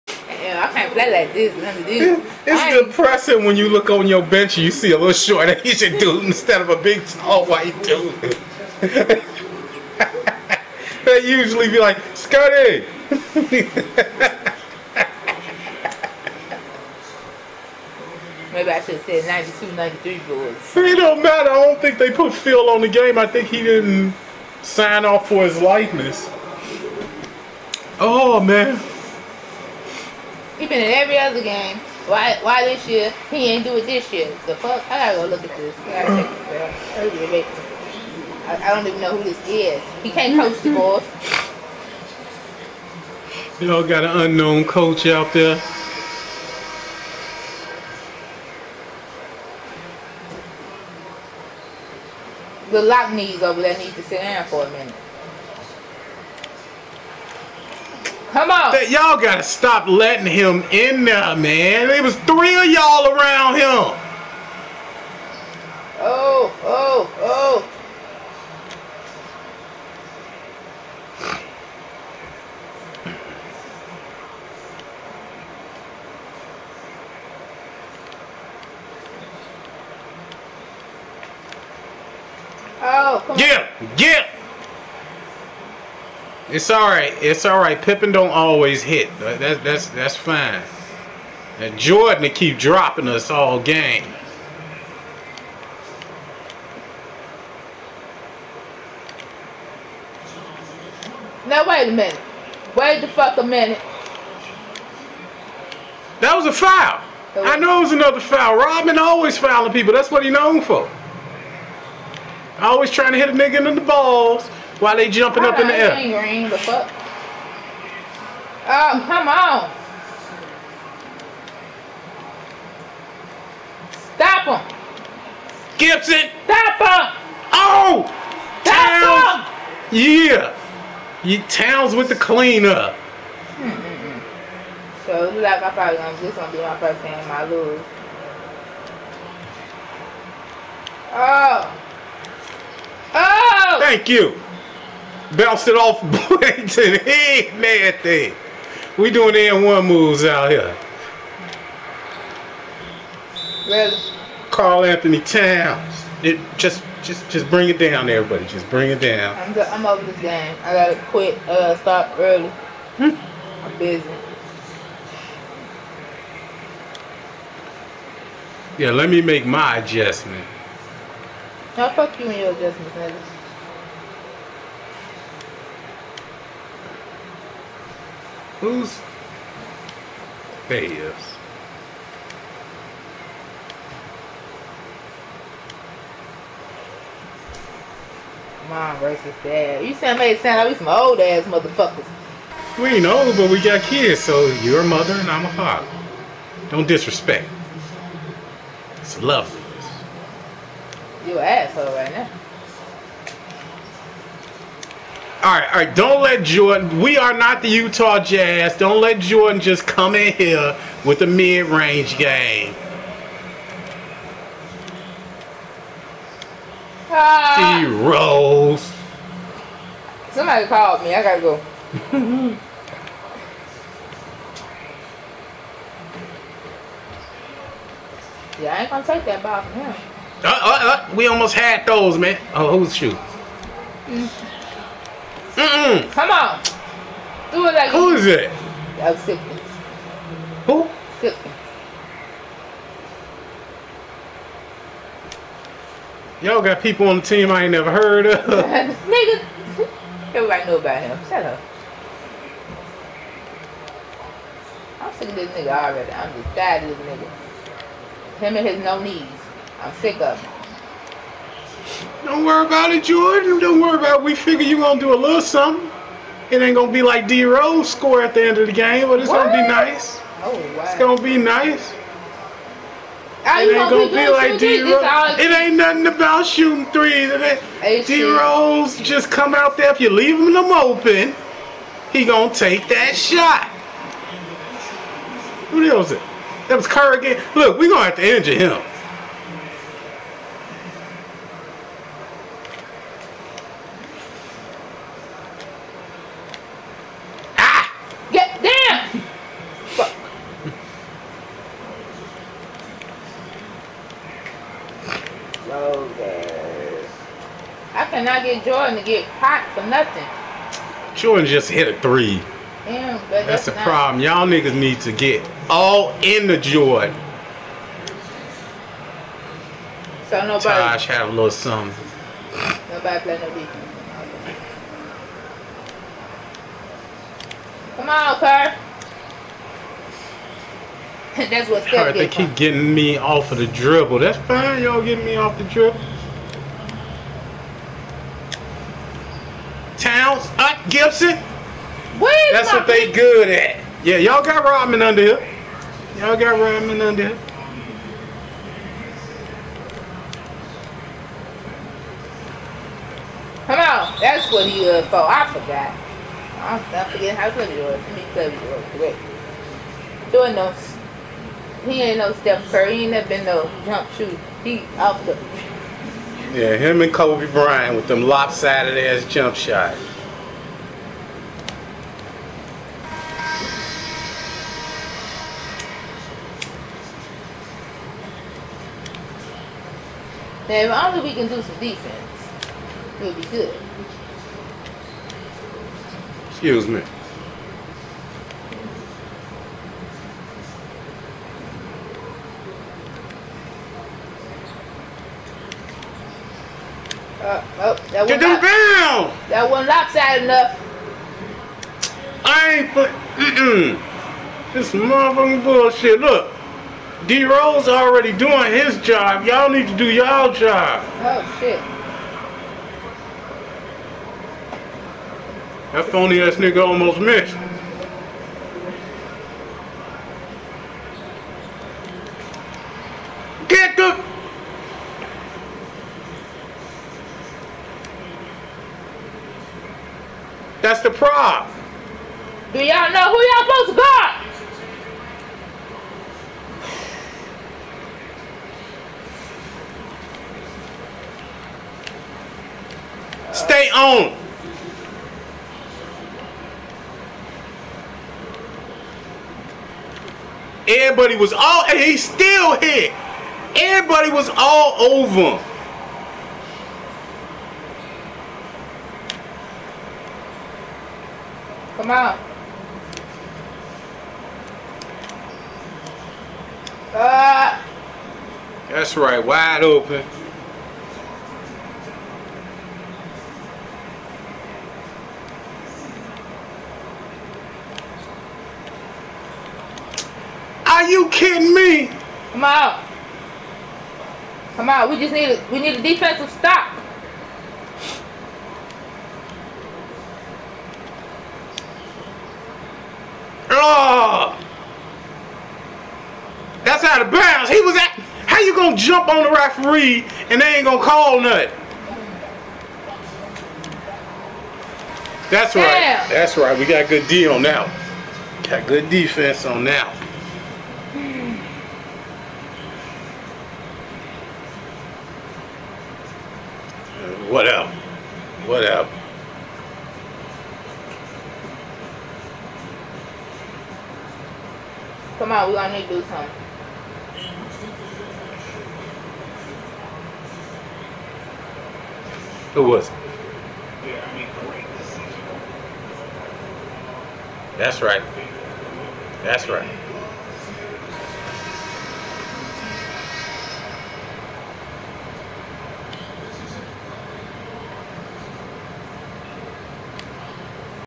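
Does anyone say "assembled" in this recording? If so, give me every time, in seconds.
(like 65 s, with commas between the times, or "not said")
not said.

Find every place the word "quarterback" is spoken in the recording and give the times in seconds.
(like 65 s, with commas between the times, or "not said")
not said.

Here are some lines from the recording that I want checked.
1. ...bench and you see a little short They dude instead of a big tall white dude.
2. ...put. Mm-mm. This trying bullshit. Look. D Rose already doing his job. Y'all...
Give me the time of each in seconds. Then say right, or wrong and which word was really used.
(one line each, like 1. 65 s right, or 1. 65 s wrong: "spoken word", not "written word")
1. 4 s wrong: "Asian", not "They"
2. 402 s wrong: "motherfucking", not "trying".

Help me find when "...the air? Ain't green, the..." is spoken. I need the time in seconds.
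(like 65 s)
115 s.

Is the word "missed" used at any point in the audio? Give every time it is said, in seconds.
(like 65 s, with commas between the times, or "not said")
417 s.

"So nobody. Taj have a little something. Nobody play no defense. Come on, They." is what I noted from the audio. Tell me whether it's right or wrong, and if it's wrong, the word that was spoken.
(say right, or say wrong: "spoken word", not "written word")
wrong: "Kerr", not "They".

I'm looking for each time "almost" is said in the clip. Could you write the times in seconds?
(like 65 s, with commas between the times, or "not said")
231 s, 416 s.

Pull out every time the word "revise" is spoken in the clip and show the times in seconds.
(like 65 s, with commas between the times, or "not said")
not said.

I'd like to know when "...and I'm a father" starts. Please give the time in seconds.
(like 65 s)
195 s.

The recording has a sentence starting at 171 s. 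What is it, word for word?
How fuck you and your adjustments, nigga?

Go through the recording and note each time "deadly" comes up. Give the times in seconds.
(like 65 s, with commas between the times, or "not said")
not said.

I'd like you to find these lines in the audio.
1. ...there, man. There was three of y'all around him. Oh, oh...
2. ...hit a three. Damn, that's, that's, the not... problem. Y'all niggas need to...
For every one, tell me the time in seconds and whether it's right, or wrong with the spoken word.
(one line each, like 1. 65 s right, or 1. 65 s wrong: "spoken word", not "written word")
1. 61 s right
2. 311 s right.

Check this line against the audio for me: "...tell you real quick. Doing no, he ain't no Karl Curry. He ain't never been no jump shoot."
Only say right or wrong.
wrong.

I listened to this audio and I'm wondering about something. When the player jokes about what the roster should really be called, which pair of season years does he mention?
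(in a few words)
92, 93.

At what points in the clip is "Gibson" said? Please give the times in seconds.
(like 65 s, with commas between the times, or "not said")
125 s, 340 s.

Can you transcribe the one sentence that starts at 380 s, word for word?
Now, if only we can do some defense, we'll be good.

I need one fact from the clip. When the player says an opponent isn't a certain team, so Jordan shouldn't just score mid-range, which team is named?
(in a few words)
Utah Jazz.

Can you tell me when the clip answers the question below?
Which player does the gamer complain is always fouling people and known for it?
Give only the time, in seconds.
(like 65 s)
108 s.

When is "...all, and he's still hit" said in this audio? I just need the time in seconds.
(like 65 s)
451 s.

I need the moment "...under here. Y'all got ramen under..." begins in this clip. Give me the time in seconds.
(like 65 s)
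345 s.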